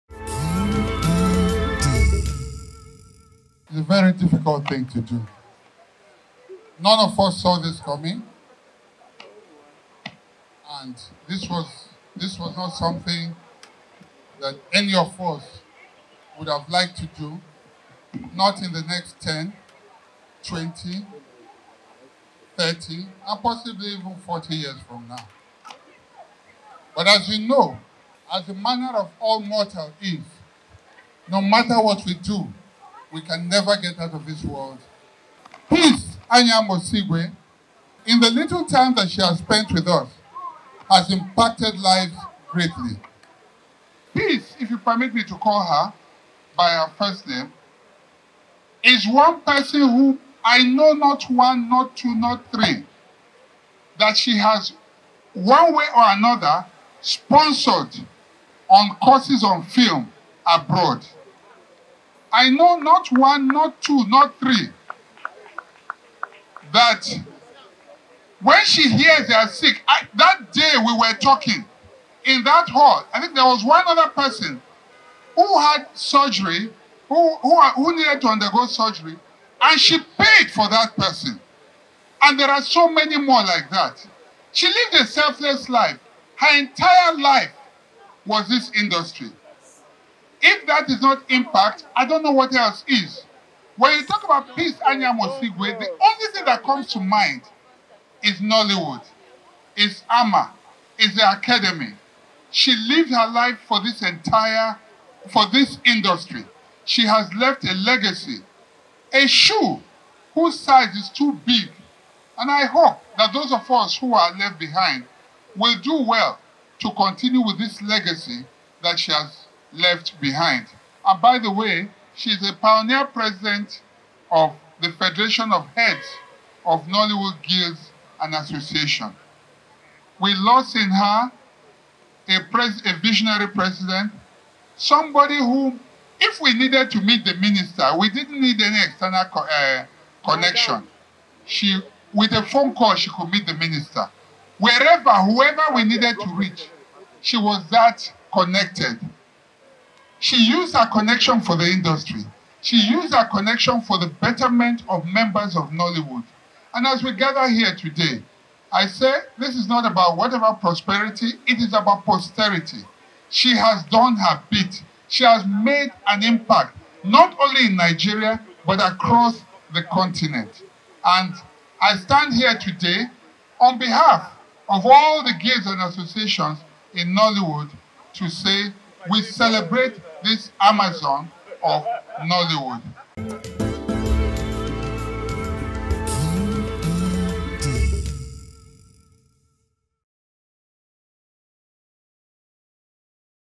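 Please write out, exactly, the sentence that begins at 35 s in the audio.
Peace Anya Mosigwe, in the little time that she has spent with us, has impacted lives greatly.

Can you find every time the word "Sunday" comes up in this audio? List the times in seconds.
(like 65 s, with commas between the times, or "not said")
not said.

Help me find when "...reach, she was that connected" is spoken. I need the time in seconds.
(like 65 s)
146 s.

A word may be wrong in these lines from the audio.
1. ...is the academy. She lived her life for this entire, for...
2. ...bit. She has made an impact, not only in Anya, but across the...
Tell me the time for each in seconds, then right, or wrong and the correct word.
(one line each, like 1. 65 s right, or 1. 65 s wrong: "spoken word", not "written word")
1. 100 s right
2. 164 s wrong: "Nigeria", not "Anya".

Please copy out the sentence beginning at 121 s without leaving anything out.
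And by the way, she's a pioneer president of the Federation of Heads of Nollywood Guilds and Association.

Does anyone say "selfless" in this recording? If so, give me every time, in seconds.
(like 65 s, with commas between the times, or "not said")
85 s.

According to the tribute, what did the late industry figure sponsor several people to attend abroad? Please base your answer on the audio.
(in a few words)
courses on film.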